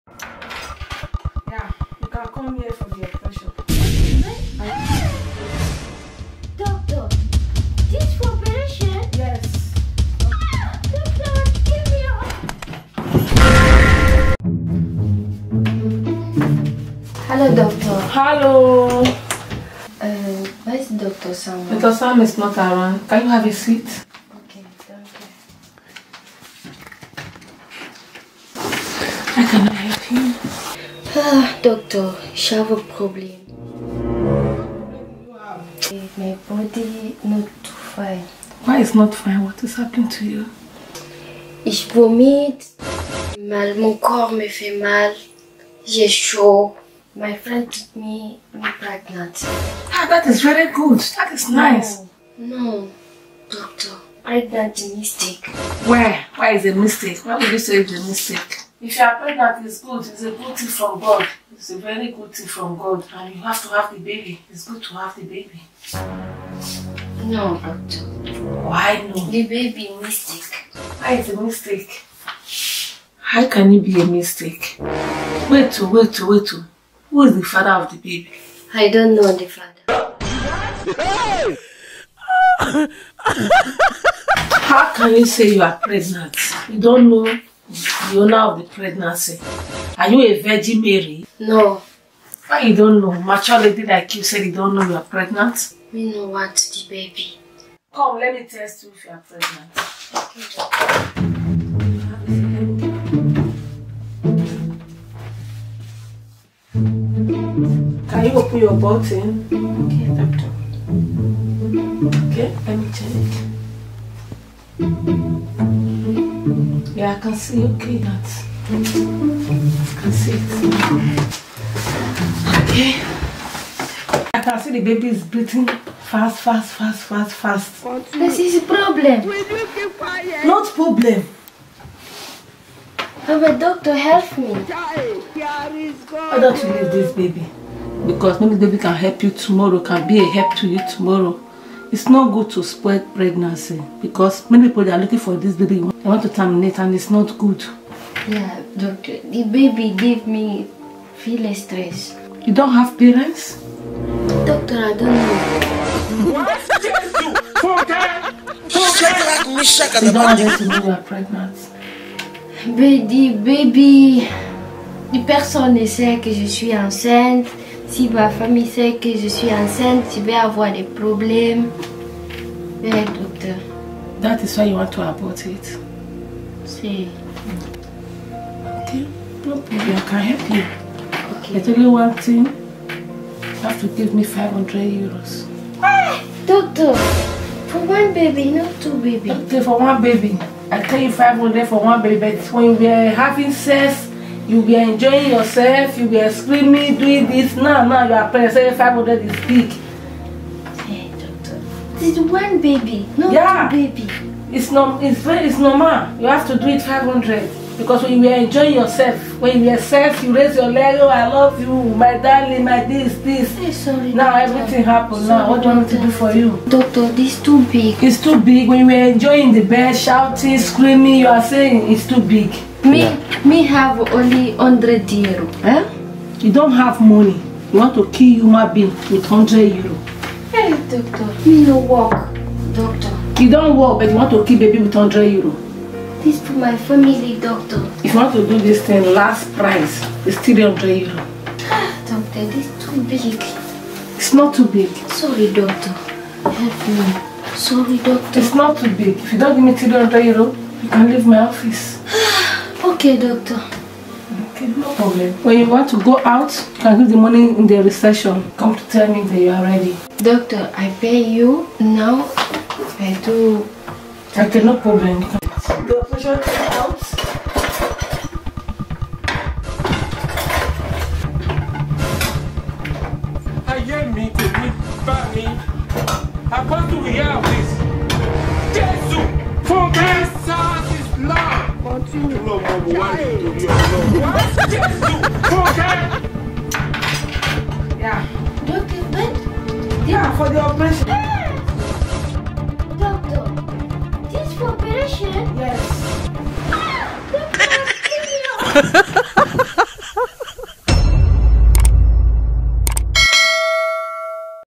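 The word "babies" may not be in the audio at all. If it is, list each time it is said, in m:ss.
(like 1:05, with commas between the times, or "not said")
3:09.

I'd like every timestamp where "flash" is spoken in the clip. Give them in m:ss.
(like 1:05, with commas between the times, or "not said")
not said.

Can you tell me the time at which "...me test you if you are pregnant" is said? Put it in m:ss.
1:38.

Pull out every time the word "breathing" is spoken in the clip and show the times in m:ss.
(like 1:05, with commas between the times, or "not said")
2:05.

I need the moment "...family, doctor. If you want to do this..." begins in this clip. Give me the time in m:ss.
3:56.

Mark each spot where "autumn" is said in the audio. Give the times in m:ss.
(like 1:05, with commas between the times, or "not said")
not said.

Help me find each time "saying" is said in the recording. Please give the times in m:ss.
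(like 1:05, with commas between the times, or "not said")
3:41.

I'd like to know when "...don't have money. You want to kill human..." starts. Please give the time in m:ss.
3:46.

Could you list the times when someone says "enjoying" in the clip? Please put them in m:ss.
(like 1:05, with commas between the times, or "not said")
3:14, 3:28, 3:39.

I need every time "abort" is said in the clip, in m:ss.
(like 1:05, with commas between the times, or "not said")
2:55.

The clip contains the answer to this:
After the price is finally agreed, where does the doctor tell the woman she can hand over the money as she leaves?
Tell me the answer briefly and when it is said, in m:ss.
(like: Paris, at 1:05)
The reception, at 4:17.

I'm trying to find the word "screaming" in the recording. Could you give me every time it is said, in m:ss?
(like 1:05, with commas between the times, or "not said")
3:16, 3:40.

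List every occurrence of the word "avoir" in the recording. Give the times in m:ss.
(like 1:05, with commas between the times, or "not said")
2:50.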